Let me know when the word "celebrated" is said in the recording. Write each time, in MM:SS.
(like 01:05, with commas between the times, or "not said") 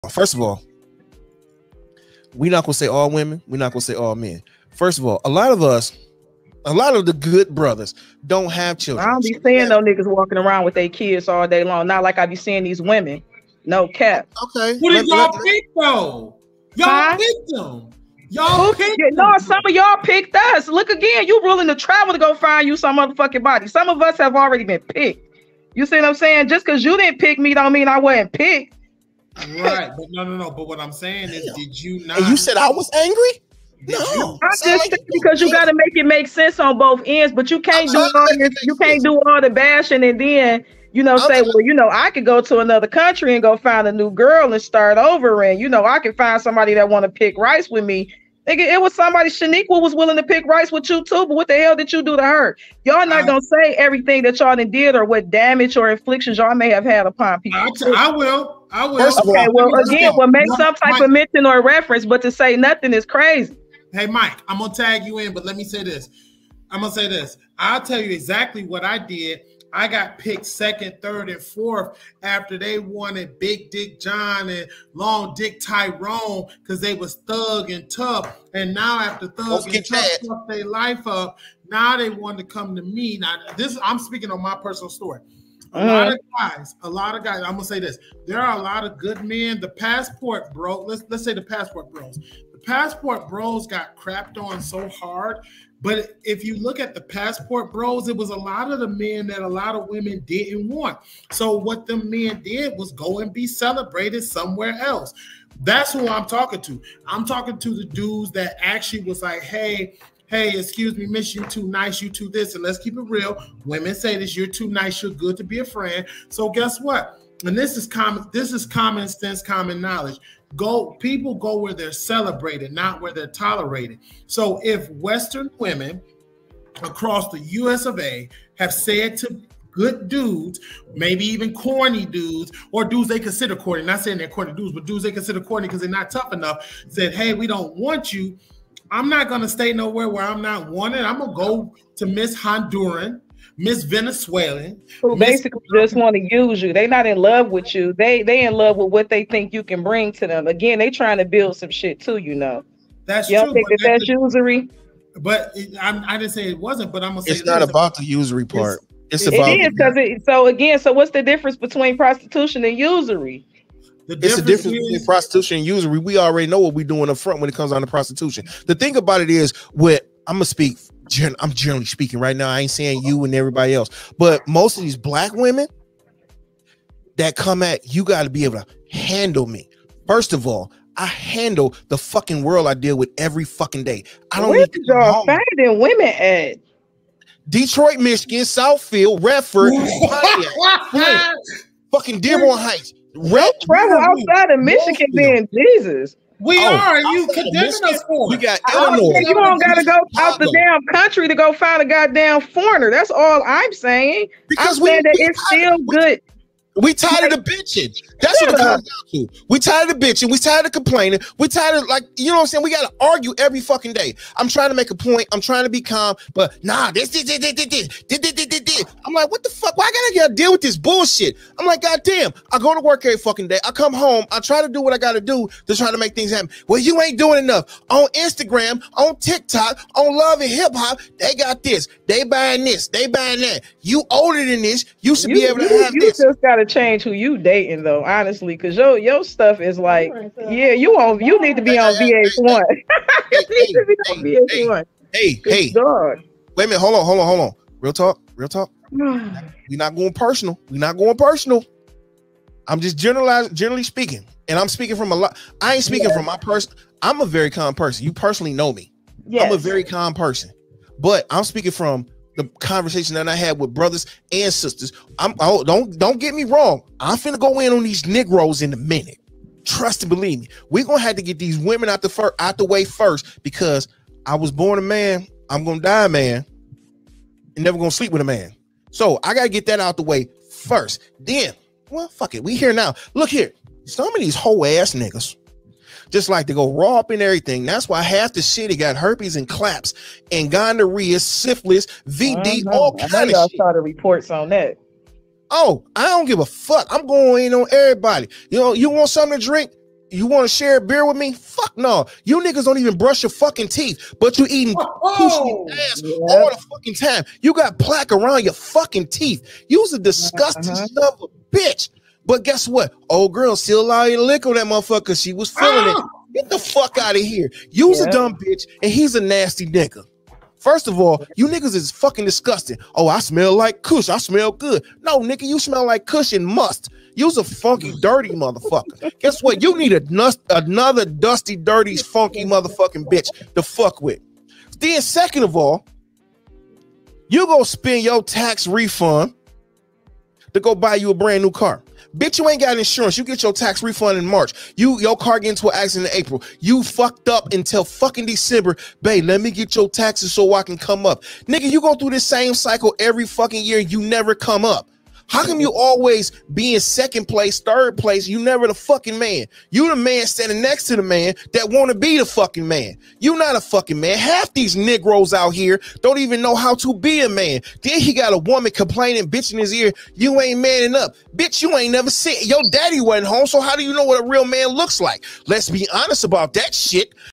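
01:43, 02:01.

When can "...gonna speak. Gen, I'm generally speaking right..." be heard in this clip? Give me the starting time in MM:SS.
02:50.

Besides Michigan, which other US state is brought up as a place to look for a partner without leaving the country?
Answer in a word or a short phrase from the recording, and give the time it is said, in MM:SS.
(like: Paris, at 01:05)
Illinois, at 03:18.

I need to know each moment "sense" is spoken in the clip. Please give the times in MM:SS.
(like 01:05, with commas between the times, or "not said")
00:36, 01:59.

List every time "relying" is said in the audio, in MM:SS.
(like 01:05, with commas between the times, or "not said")
not said.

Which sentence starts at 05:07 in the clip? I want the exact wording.
You got plaque around your fucking teeth.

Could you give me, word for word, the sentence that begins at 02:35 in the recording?
But it, I, I, didn't say it wasn't.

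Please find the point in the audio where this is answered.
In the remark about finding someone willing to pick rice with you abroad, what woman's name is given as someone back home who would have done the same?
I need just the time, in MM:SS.
00:49.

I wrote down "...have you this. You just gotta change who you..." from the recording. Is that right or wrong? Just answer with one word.
right.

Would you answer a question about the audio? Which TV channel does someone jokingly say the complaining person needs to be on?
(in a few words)
VH1.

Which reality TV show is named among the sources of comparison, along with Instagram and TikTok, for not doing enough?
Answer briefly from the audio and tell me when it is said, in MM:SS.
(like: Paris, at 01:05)
Love and Hip Hop, at 03:50.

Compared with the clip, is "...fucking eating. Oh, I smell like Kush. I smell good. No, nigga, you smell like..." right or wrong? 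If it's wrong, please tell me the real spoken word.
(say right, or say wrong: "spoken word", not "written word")
wrong: "disgusting", not "eating".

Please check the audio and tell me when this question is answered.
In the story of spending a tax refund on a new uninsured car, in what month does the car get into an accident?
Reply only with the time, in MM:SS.
05:46.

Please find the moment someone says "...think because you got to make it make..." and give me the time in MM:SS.
00:34.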